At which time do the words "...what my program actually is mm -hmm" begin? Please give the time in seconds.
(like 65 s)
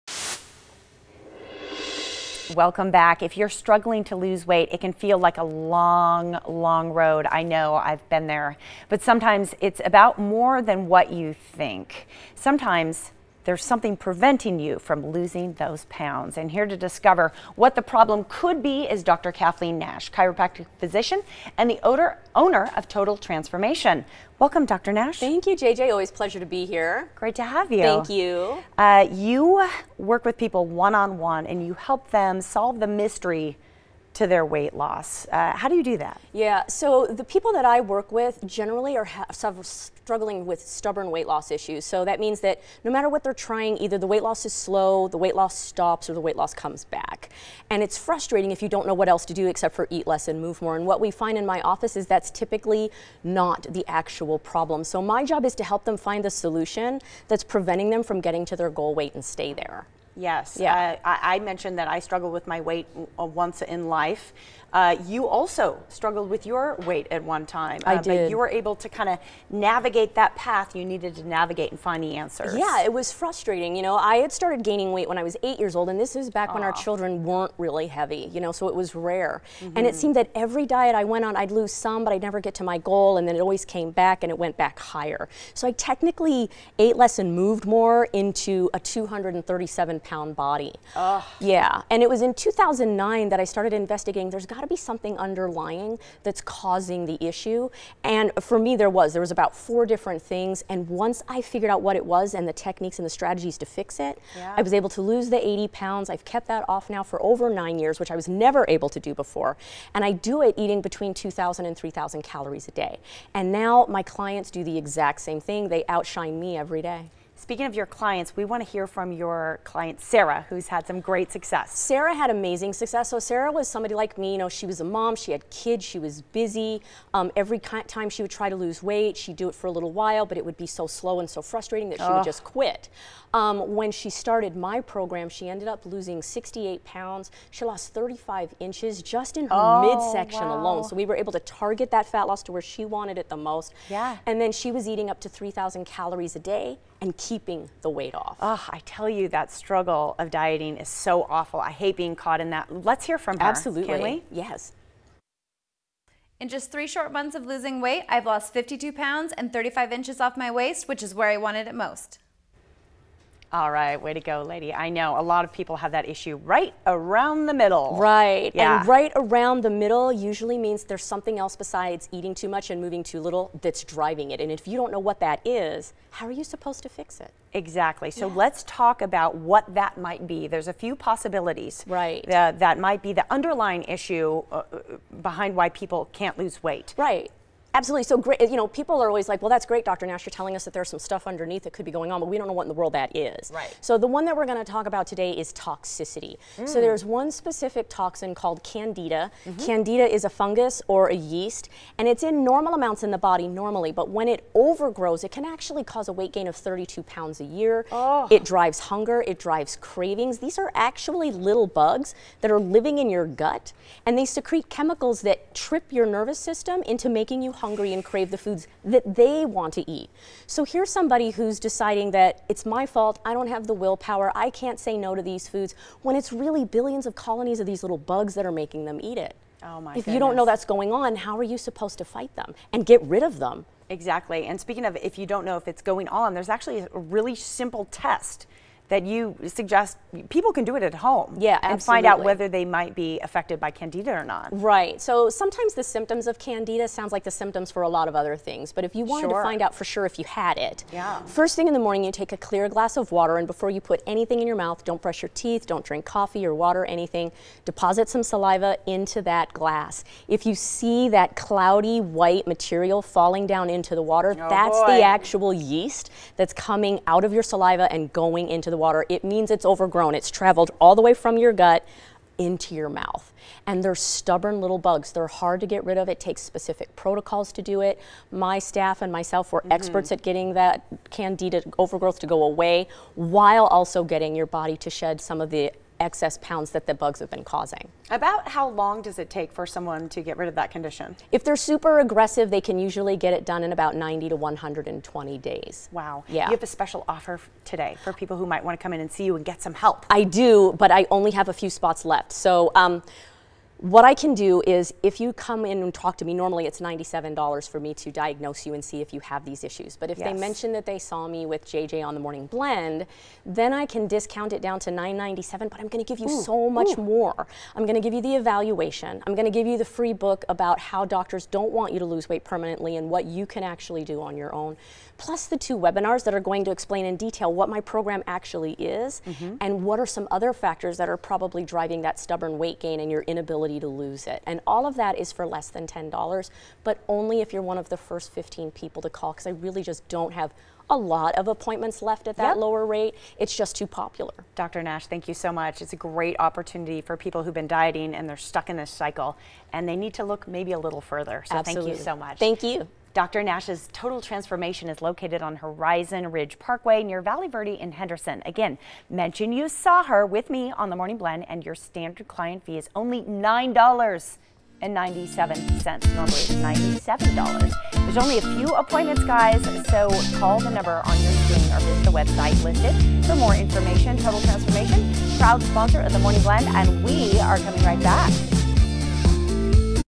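327 s.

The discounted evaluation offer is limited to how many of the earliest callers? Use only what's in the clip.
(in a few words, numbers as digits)
15.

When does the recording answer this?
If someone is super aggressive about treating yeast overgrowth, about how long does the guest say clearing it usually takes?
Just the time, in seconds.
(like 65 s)
293 s.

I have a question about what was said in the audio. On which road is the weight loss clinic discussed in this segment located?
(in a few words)
Horizon Ridge Parkway.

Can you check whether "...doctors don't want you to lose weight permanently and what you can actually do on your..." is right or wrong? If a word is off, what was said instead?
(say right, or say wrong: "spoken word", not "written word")
right.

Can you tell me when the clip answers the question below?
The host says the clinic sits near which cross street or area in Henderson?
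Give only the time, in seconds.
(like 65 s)
357 s.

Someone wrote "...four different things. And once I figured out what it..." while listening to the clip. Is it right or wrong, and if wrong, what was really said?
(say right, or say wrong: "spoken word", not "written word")
right.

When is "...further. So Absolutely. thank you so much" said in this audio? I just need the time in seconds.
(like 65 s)
351 s.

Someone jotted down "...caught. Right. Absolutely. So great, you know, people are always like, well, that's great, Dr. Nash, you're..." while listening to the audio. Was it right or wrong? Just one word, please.
wrong.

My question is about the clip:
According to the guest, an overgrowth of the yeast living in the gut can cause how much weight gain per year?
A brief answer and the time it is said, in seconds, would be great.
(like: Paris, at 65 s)
32 pounds, at 206 s.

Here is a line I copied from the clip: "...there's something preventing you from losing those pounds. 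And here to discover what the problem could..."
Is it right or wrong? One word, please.
right.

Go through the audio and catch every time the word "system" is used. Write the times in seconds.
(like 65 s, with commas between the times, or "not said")
216 s.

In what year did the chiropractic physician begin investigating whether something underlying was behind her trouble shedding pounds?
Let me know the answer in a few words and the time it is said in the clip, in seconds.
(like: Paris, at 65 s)
2009, at 92 s.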